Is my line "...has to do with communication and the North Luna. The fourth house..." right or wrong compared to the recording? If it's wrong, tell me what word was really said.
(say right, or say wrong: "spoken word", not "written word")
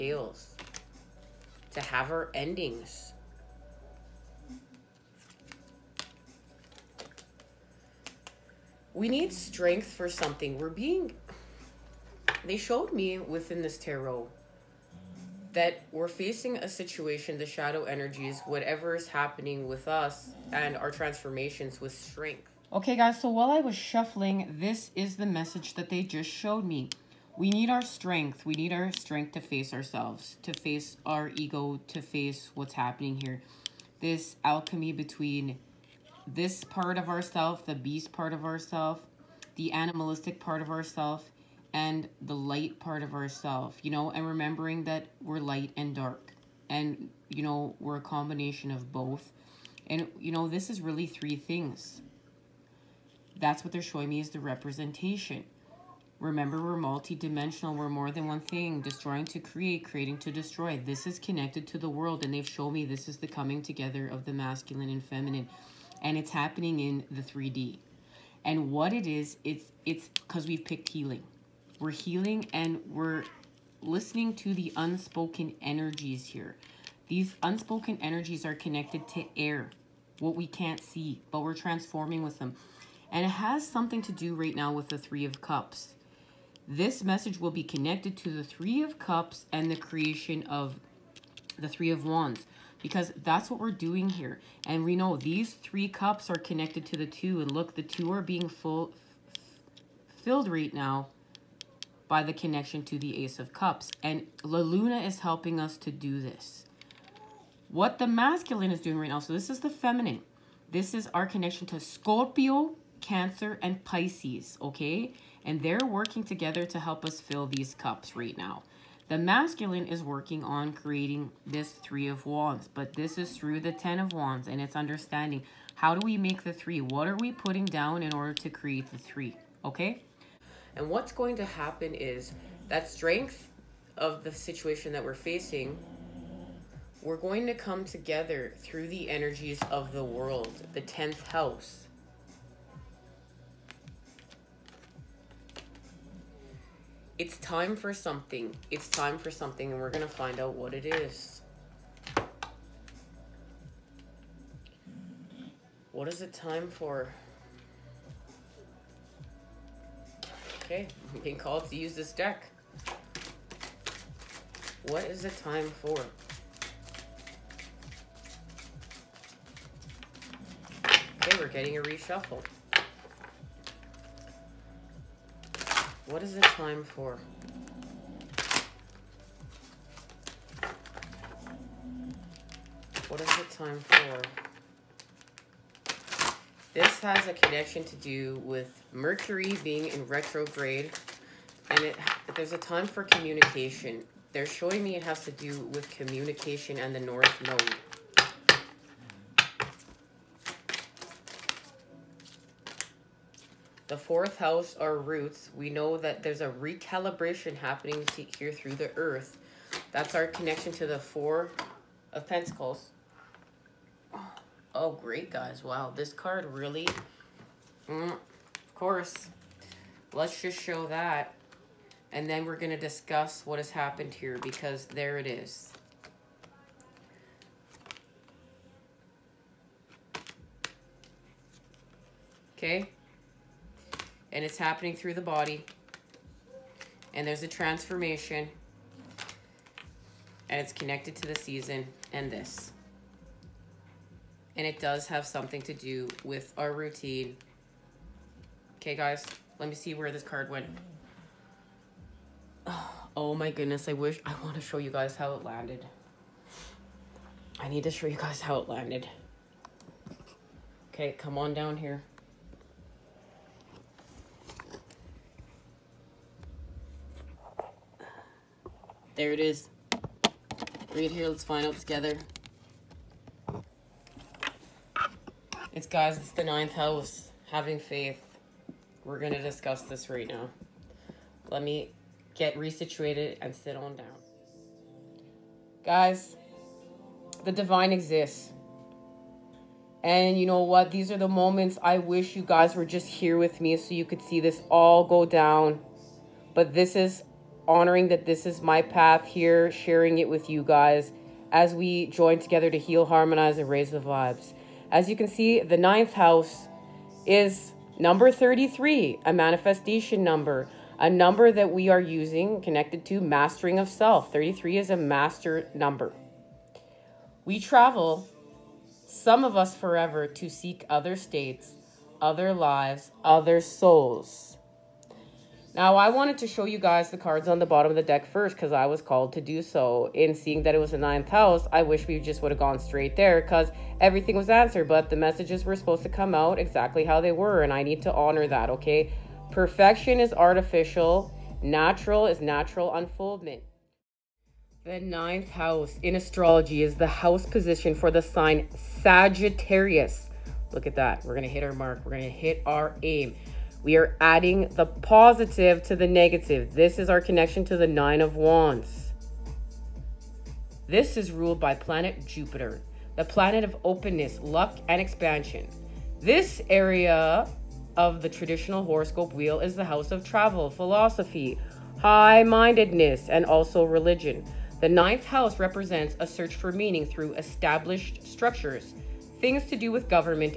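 wrong: "Node", not "Luna".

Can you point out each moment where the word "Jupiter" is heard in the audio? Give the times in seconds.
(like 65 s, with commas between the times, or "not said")
362 s.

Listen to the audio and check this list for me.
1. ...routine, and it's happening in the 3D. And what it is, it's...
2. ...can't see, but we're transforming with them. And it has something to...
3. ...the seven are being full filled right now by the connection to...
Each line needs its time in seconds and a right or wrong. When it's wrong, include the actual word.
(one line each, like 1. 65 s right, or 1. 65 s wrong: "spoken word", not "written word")
1. 65 s wrong: "feminine", not "routine"
2. 80 s right
3. 97 s wrong: "two", not "seven".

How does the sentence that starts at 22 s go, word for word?
Okay, guys, so while I was shuffling, this is the message that they just showed me.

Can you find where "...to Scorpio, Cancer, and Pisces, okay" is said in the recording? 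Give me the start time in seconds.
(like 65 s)
111 s.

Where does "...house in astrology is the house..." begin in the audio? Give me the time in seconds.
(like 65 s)
345 s.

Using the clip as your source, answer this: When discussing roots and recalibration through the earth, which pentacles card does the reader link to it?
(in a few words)
Four of Pentacles.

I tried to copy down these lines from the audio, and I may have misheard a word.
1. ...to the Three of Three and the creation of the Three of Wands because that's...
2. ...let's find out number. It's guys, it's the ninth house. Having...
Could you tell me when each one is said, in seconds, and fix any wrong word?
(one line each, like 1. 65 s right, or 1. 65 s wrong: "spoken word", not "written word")
1. 88 s wrong: "Cups", not "Three"
2. 271 s wrong: "together", not "number".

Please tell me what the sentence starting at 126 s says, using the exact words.
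What are we putting down in order to create the three, okay?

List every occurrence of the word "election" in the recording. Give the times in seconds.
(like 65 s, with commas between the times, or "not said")
not said.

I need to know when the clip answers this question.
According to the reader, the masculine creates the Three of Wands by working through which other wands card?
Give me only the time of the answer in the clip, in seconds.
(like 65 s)
123 s.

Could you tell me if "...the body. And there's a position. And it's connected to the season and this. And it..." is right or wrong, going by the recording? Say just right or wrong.
wrong.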